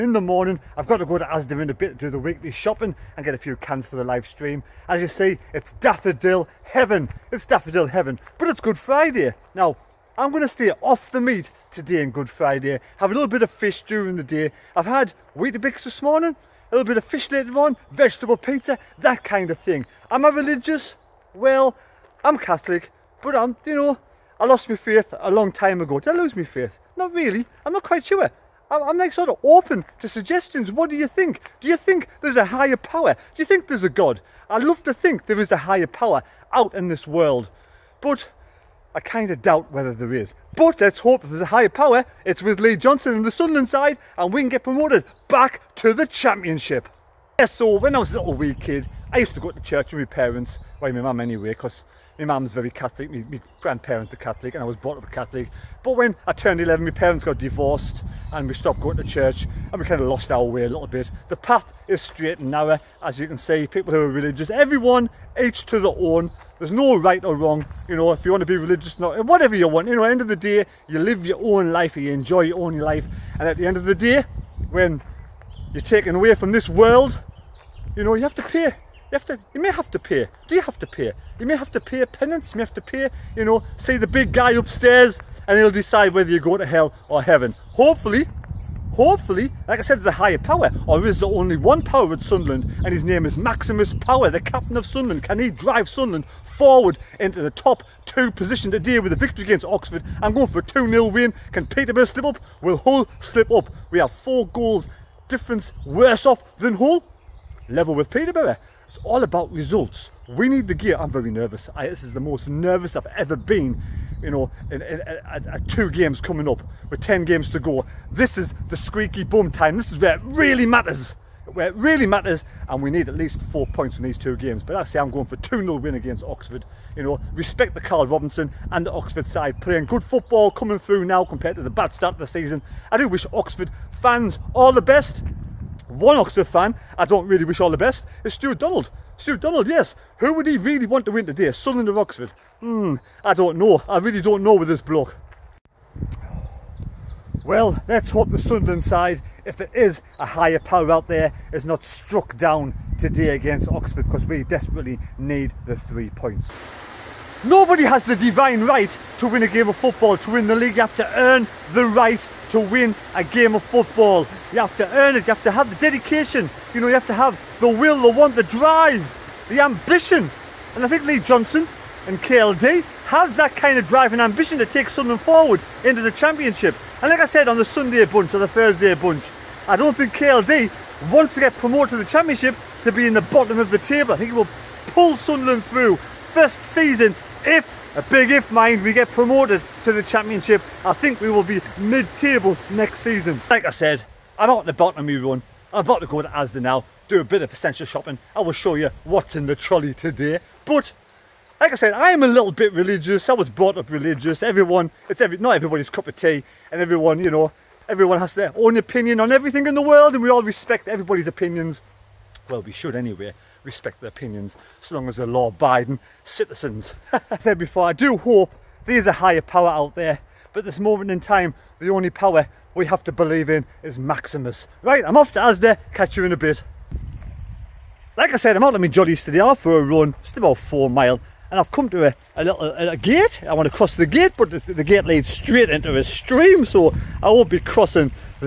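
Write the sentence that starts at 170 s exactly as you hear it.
And I think Lee Johnson and KLD has that kind of drive and ambition to take Sunderland forward into the championship.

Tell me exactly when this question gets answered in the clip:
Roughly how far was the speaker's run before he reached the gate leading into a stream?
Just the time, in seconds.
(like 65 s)
230 s.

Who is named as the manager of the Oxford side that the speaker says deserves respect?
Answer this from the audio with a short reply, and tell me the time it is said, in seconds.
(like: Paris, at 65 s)
Carl Robinson, at 127 s.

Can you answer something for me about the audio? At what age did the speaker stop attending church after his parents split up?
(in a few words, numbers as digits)
11.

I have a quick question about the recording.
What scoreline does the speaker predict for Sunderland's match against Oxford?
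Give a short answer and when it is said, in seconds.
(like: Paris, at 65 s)
2-0, at 100 s.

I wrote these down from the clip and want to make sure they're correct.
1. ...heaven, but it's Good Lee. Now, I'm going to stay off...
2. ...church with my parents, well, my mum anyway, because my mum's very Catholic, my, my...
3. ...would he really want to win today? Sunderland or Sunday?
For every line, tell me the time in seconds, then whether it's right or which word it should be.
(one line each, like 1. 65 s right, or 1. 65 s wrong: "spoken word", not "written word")
1. 7 s wrong: "Friday", not "Lee"
2. 49 s right
3. 140 s wrong: "Oxford", not "Sunday".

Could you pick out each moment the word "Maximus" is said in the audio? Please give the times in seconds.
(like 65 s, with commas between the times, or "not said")
93 s, 223 s.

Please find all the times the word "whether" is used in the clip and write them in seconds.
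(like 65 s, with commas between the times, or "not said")
39 s, 86 s.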